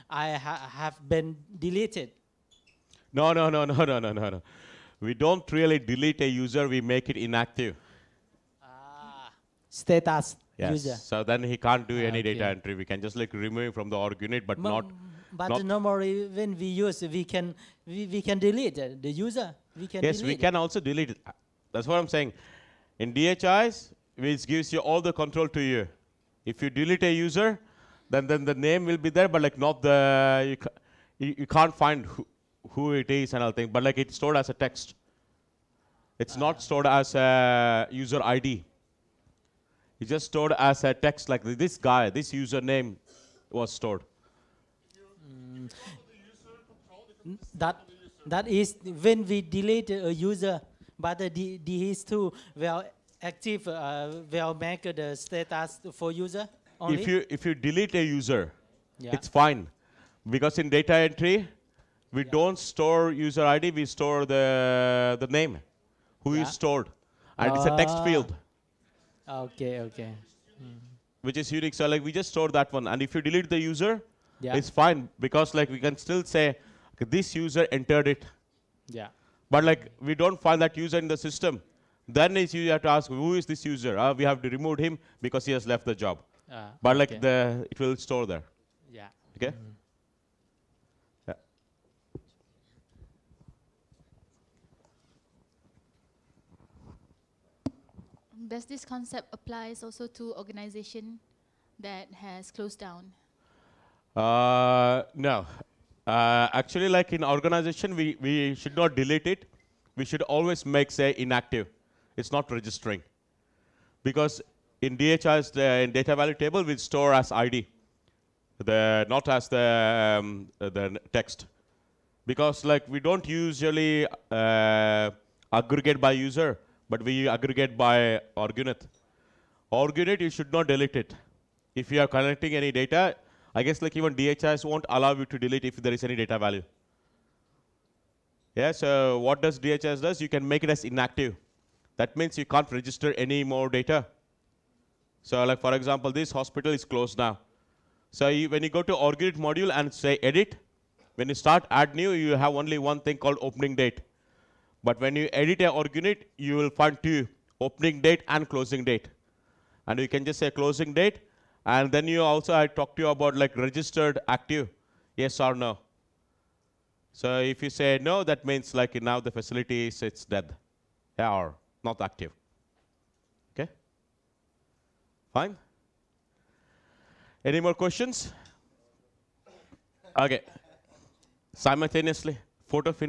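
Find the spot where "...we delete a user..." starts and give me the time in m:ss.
0:49.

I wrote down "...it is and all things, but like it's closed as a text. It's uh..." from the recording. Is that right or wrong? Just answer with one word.
wrong.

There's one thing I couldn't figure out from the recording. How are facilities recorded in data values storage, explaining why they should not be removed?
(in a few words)
as ID.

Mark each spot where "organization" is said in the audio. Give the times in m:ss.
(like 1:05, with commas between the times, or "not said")
1:40, 1:47.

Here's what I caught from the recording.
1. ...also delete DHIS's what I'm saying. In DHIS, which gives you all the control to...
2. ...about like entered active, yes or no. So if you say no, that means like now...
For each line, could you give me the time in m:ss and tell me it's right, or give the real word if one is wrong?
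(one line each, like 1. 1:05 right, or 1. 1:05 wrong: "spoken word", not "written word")
1. 0:20 wrong: "That", not "DHIS"
2. 2:43 wrong: "registered", not "entered".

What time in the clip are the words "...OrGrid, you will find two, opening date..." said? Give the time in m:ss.
2:35.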